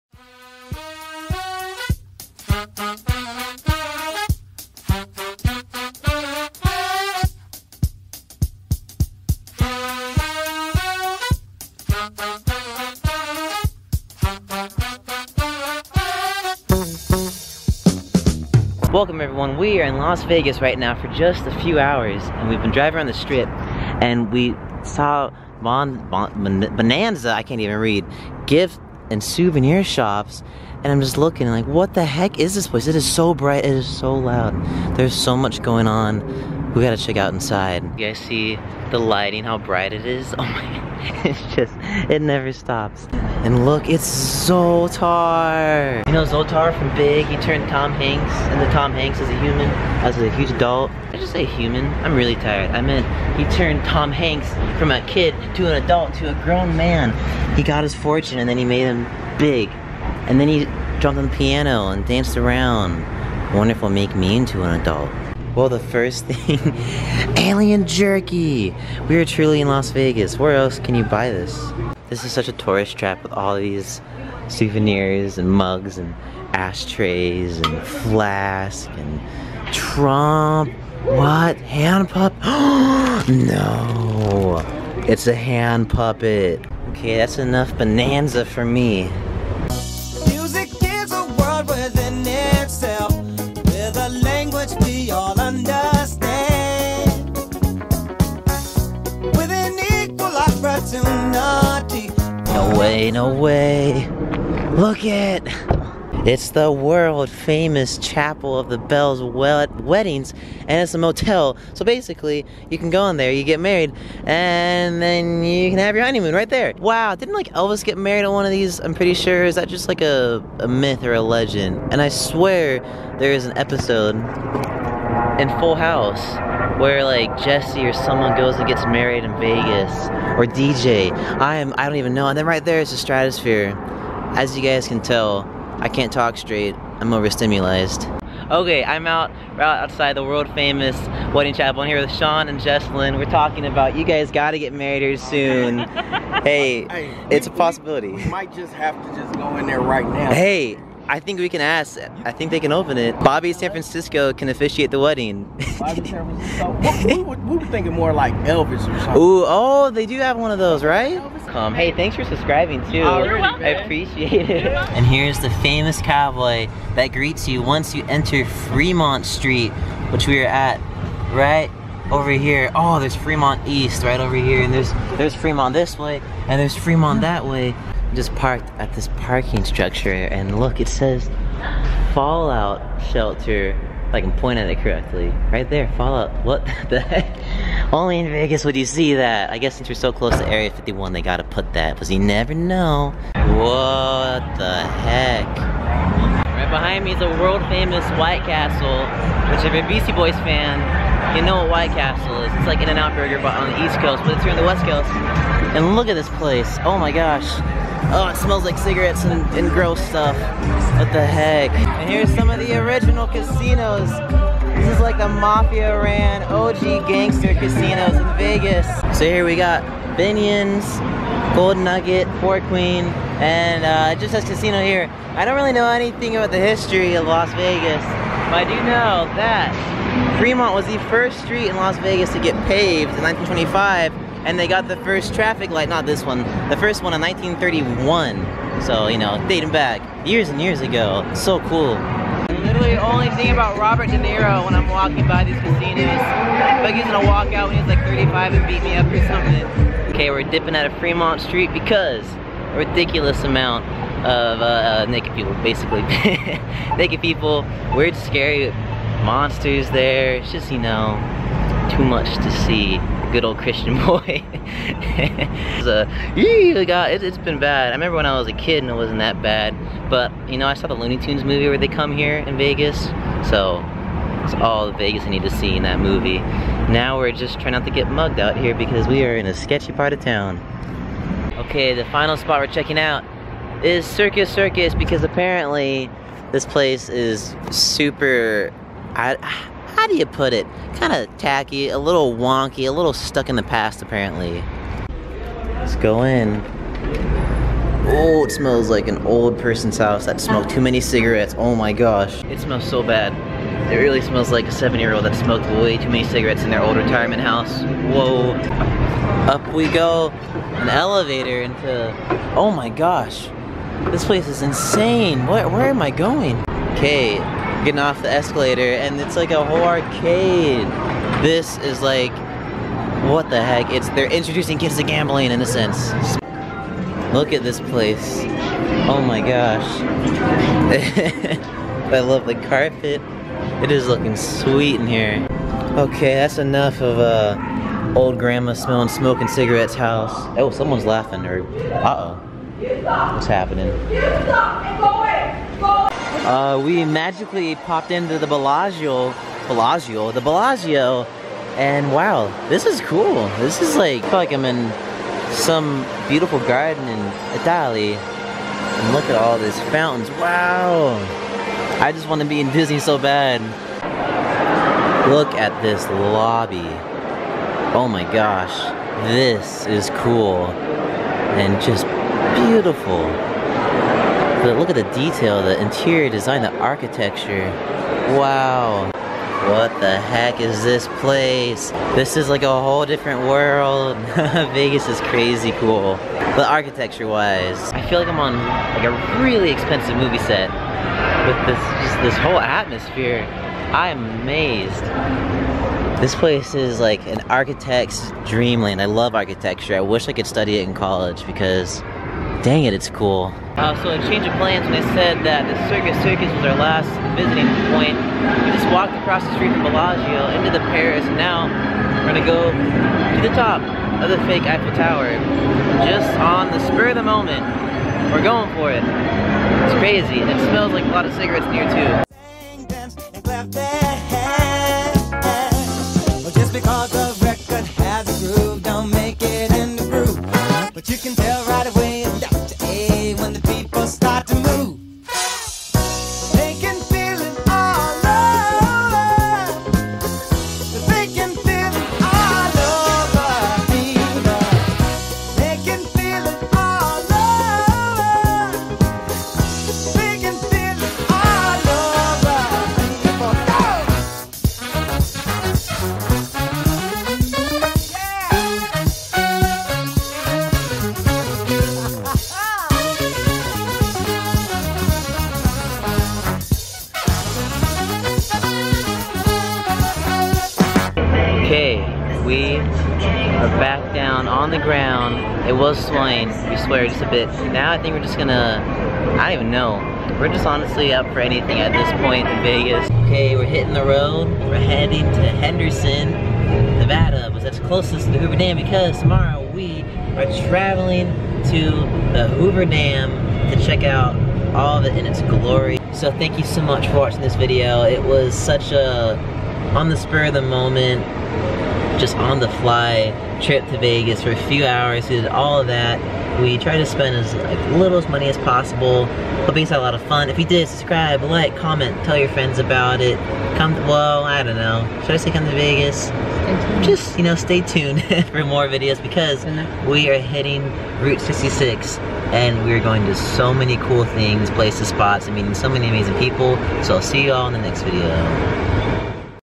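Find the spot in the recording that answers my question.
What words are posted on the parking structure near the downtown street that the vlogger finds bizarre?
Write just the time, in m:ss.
3:02.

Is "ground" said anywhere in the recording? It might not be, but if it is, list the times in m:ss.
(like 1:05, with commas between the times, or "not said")
7:54.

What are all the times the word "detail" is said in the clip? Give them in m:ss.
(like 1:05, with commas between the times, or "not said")
6:15.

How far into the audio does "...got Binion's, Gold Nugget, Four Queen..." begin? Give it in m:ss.
3:39.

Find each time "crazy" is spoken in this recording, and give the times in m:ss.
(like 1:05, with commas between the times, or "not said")
6:25, 6:59.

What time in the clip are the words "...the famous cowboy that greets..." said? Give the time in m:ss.
2:45.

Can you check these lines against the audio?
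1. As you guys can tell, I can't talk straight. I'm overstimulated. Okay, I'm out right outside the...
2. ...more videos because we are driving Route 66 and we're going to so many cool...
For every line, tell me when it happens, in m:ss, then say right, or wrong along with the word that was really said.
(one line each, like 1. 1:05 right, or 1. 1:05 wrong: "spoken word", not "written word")
1. 2:14 right
2. 8:38 wrong: "hitting", not "driving".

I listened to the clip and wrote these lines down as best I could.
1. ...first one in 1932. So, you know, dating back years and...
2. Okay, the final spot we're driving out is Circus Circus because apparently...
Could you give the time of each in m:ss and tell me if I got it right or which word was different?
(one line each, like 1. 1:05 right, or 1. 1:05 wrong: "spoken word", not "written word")
1. 3:56 wrong: "1931", not "1932"
2. 4:41 wrong: "checking", not "driving".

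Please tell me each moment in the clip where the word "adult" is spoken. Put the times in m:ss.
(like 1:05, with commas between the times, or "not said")
0:50, 0:55, 1:04.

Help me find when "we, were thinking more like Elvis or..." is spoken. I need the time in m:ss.
2:37.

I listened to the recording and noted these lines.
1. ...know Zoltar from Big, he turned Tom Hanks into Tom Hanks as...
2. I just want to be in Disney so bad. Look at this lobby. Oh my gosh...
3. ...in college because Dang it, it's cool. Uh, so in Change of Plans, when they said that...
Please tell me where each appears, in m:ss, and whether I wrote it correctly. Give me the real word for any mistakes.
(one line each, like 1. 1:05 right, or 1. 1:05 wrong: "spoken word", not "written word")
1. 0:46 right
2. 6:02 right
3. 6:40 right.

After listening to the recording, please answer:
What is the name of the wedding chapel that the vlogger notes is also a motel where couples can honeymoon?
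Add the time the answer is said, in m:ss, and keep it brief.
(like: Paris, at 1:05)
Chapel of the Bells, at 1:47.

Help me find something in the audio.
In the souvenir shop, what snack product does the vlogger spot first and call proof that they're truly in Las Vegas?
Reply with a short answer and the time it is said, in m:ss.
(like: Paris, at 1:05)
alien jerky, at 1:07.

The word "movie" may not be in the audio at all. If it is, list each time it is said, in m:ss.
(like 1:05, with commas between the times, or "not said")
4:31, 4:35, 6:30.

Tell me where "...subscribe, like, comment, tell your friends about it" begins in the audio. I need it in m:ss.
8:30.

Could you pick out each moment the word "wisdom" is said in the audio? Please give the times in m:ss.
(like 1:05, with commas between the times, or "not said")
not said.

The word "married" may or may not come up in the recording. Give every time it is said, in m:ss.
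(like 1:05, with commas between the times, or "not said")
1:53, 1:57, 2:08, 2:24.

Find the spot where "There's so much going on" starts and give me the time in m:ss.
0:34.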